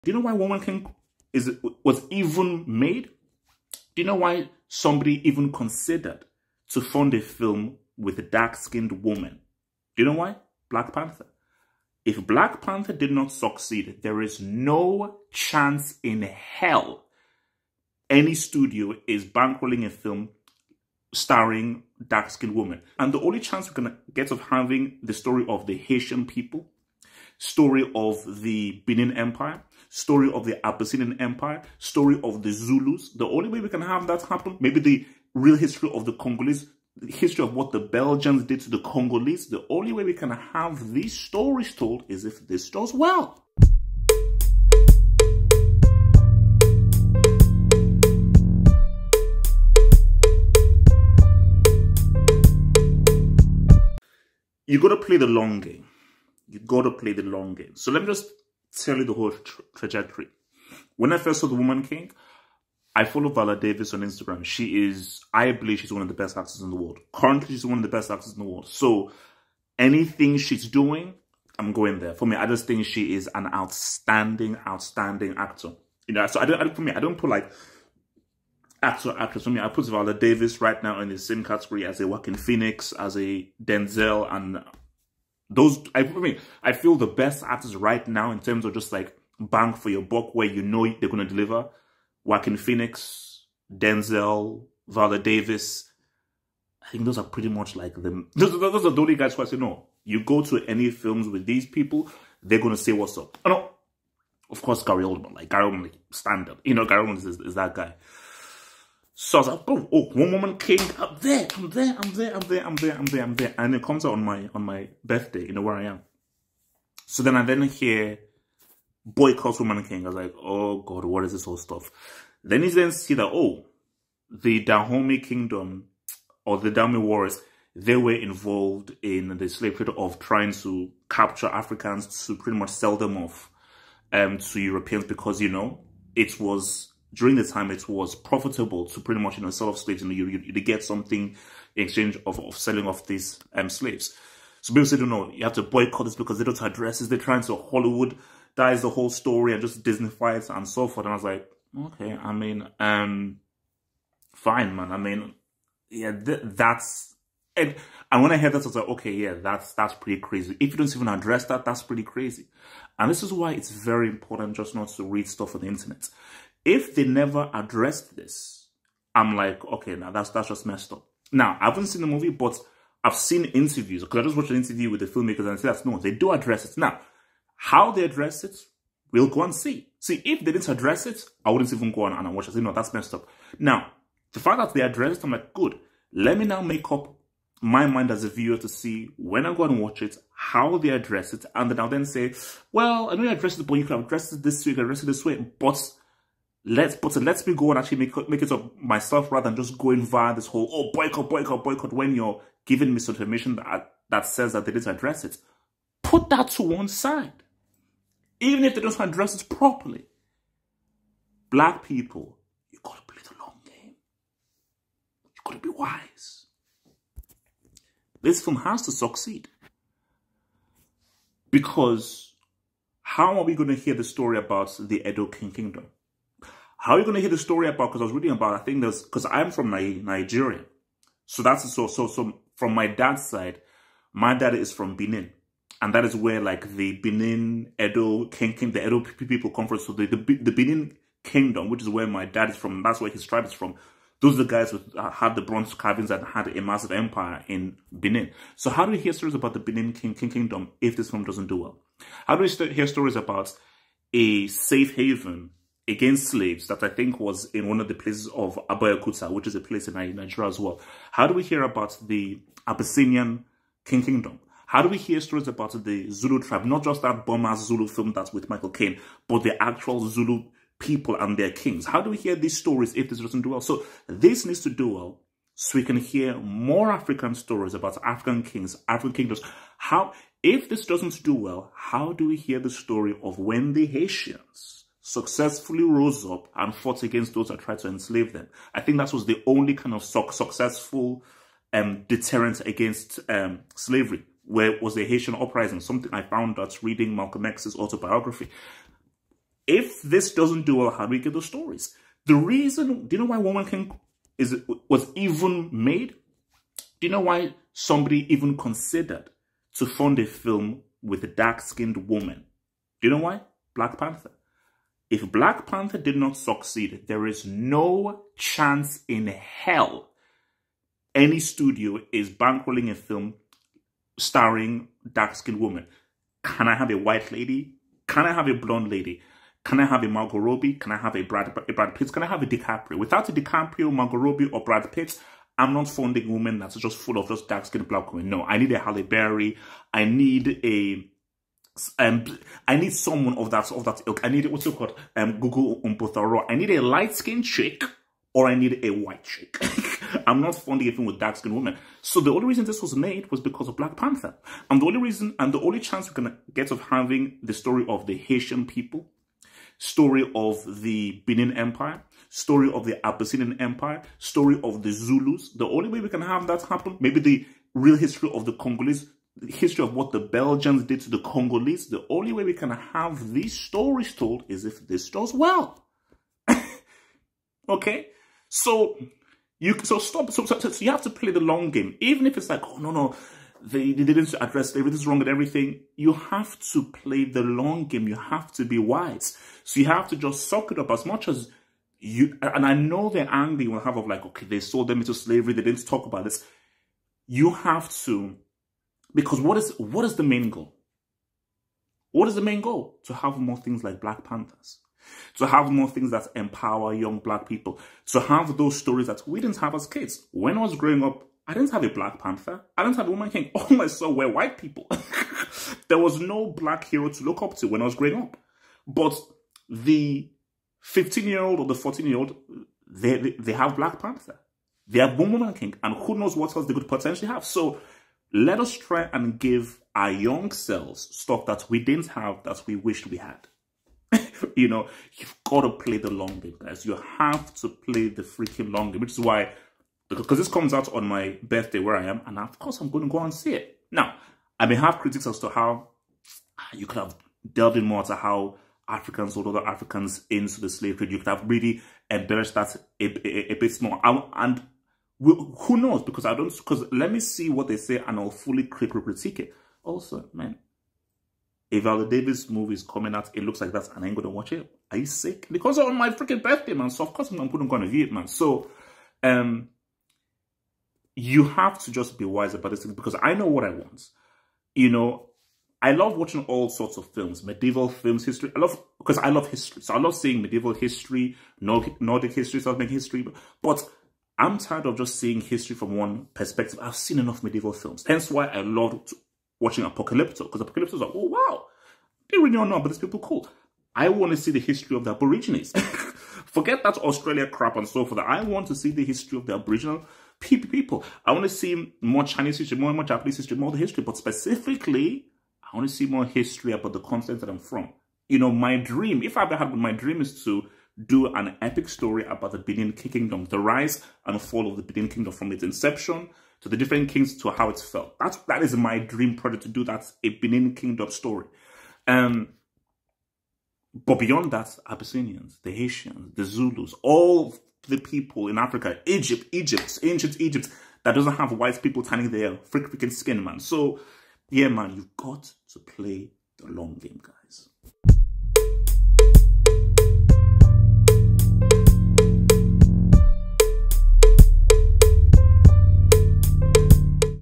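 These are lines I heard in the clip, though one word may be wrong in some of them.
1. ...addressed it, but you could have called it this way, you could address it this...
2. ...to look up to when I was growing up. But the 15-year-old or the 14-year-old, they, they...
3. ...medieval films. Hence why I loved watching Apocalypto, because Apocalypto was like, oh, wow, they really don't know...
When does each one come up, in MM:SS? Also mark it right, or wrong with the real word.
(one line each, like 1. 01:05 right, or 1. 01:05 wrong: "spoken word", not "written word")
1. 03:13 wrong: "addressed", not "called"
2. 06:57 right
3. 08:07 right.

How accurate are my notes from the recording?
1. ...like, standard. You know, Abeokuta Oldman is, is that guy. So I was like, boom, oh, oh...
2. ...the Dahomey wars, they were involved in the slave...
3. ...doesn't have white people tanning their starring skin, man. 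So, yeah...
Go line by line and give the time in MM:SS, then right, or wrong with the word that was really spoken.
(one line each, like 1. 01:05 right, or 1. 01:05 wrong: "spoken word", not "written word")
1. 01:45 wrong: "Gary", not "Abeokuta"
2. 02:06 right
3. 08:51 wrong: "freaking", not "starring".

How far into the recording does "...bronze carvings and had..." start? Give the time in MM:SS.
04:05.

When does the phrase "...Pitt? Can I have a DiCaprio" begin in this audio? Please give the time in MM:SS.
05:31.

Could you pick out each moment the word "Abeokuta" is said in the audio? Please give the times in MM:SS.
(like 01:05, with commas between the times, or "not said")
04:18.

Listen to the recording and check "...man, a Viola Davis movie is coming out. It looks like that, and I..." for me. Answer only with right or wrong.
right.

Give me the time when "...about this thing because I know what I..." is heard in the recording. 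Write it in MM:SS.
07:52.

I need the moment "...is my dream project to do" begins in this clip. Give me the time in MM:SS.
08:38.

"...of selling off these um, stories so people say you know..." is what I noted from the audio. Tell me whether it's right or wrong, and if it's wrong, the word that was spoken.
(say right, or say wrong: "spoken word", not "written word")
wrong: "slaves", not "stories".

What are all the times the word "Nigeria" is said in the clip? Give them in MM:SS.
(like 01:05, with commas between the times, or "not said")
03:49, 04:20.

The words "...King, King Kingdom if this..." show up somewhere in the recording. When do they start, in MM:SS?
04:09.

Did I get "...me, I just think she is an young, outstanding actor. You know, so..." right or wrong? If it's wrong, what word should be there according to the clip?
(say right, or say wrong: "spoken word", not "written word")
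wrong: "outstanding", not "young".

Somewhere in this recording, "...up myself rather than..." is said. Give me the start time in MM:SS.
03:18.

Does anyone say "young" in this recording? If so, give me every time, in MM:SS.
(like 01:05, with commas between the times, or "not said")
06:46, 07:10.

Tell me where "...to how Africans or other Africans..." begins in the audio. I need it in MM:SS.
07:28.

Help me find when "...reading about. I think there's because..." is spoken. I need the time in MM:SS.
03:48.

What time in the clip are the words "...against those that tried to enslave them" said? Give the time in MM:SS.
04:47.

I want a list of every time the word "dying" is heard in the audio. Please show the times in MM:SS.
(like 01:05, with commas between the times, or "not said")
not said.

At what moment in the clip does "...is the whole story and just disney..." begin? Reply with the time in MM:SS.
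02:28.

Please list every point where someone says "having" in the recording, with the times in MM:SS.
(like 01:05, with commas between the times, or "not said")
00:24, 05:56.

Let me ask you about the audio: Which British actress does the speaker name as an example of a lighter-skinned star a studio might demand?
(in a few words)
Gugu Mbatha-Raw.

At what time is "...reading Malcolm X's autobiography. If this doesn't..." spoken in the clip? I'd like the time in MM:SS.
04:56.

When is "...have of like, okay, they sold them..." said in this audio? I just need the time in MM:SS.
06:33.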